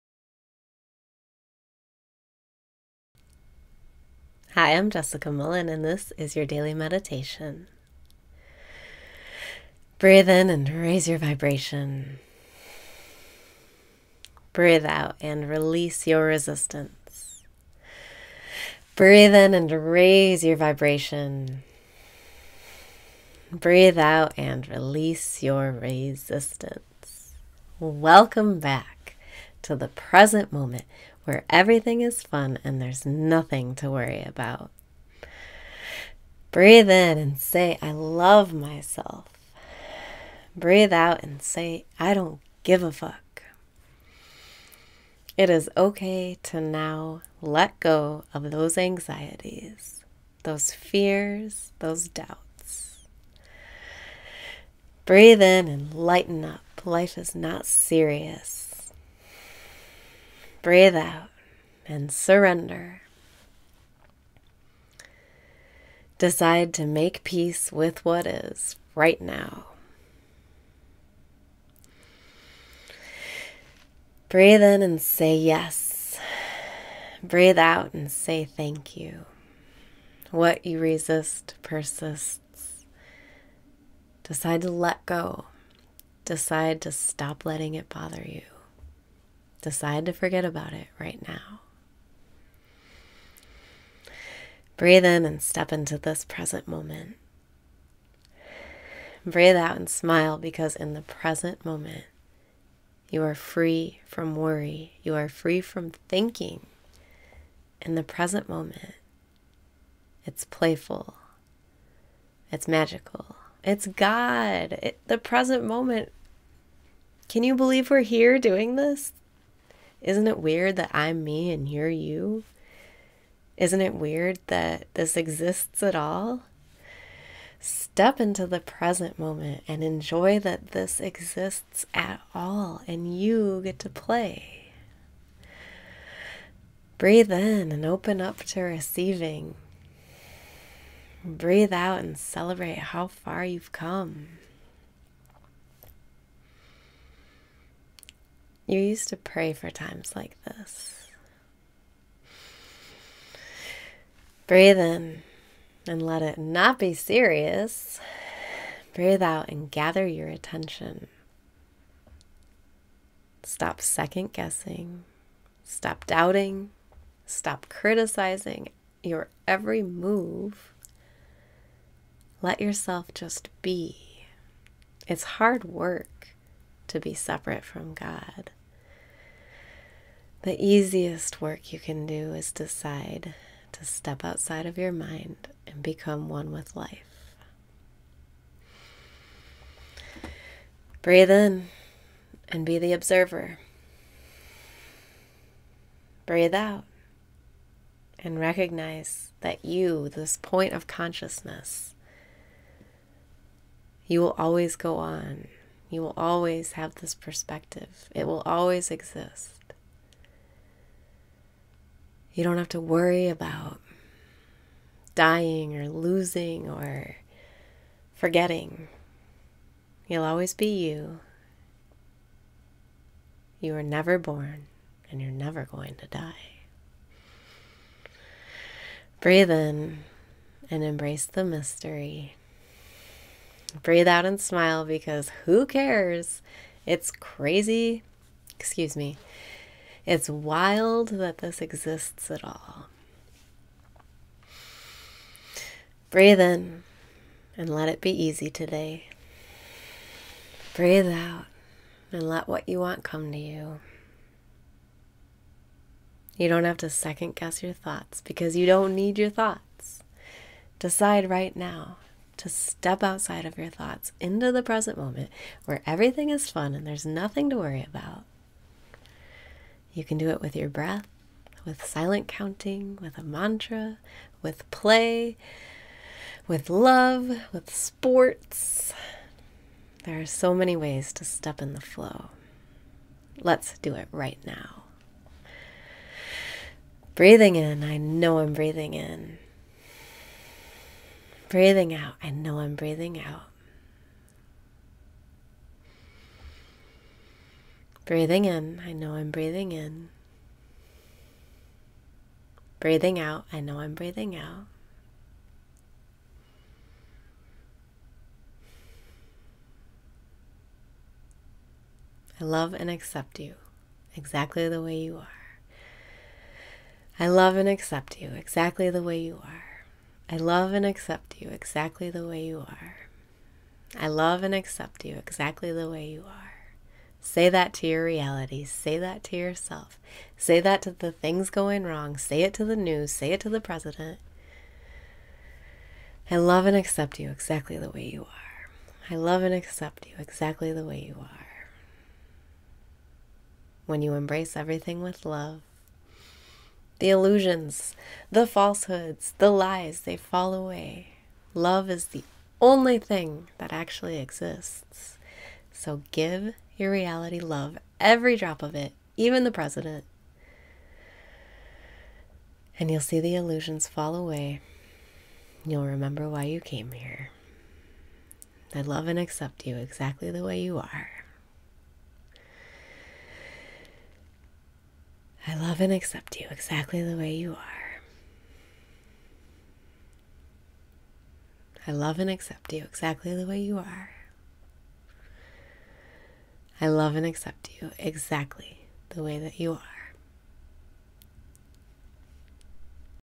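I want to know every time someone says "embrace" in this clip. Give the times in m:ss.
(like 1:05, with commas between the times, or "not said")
3:50, 5:44.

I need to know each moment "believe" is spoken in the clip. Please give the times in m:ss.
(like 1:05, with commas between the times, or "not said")
1:57.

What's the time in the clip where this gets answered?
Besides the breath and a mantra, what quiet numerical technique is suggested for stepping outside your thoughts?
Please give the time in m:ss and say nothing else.
4:31.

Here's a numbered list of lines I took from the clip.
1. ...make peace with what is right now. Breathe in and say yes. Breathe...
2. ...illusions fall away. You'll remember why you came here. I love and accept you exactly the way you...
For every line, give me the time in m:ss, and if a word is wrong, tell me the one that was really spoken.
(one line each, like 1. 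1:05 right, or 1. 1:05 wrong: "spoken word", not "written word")
1. 1:06 right
2. 6:03 right.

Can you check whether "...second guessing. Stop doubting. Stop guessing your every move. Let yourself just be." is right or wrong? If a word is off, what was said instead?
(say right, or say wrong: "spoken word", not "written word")
wrong: "criticizing", not "guessing".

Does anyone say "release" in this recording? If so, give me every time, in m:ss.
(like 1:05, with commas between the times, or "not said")
0:15, 0:24.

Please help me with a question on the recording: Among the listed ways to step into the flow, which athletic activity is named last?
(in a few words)
Sports.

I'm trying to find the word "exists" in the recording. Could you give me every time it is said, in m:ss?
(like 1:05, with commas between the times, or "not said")
2:05, 2:10, 3:28, 4:01, 5:54.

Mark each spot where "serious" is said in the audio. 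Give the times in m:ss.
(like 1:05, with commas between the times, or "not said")
0:57, 2:36.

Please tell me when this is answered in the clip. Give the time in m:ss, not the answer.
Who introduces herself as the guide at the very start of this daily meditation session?
0:04.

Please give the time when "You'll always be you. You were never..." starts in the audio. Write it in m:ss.
3:40.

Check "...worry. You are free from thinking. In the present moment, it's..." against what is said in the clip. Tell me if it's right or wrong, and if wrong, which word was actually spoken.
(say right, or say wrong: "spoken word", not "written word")
right.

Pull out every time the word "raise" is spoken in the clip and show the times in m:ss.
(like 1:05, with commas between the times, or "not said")
0:10, 0:19.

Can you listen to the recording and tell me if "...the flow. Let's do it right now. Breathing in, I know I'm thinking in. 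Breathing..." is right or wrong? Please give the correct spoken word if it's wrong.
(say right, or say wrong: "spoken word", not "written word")
wrong: "breathing", not "thinking".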